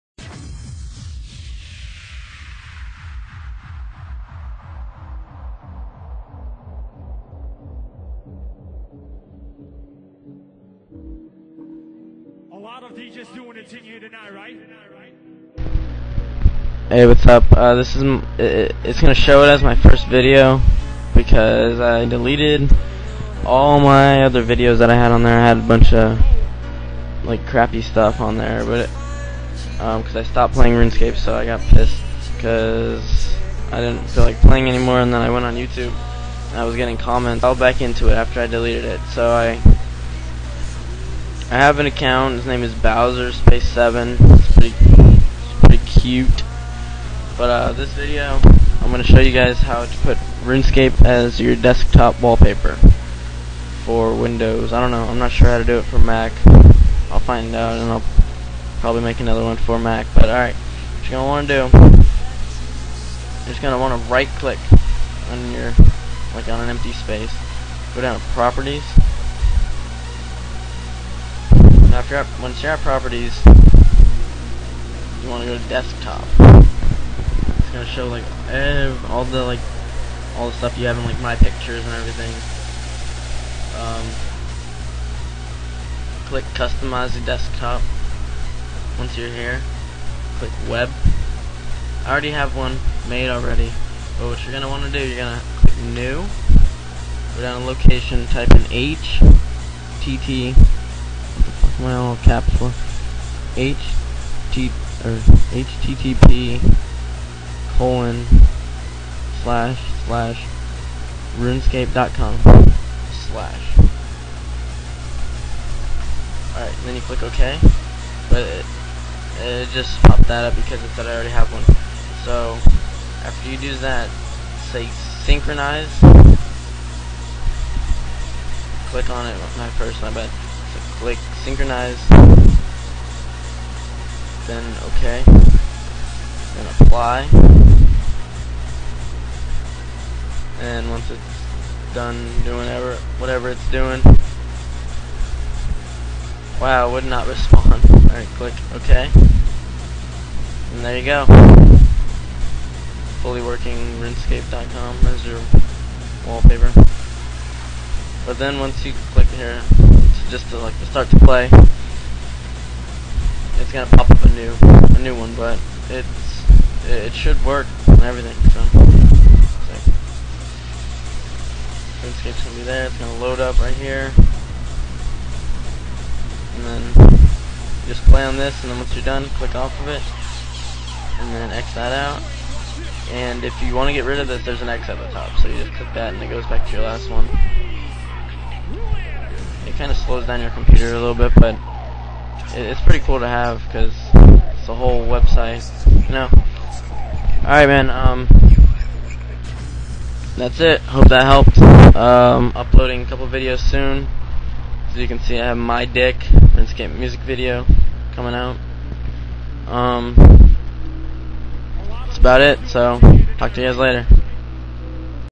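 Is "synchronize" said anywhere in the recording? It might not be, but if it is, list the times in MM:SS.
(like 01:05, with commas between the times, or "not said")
02:05, 02:11.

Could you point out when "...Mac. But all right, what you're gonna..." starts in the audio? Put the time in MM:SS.
00:59.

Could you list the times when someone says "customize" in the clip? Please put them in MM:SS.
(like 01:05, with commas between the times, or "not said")
01:26.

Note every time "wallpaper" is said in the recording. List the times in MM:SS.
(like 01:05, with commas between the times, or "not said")
00:52, 02:36.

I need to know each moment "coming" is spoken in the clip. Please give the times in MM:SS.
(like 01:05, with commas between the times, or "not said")
03:28.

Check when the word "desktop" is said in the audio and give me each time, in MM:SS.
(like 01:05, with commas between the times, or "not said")
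00:51, 01:15, 01:27.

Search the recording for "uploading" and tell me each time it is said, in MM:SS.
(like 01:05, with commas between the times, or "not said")
03:22.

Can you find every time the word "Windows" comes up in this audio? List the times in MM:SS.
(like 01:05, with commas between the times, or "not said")
00:54.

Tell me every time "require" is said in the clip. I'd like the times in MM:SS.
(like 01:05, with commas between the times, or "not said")
not said.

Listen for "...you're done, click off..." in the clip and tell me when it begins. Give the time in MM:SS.
02:58.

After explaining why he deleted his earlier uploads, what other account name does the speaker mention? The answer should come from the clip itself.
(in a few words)
Bowser Space Seven.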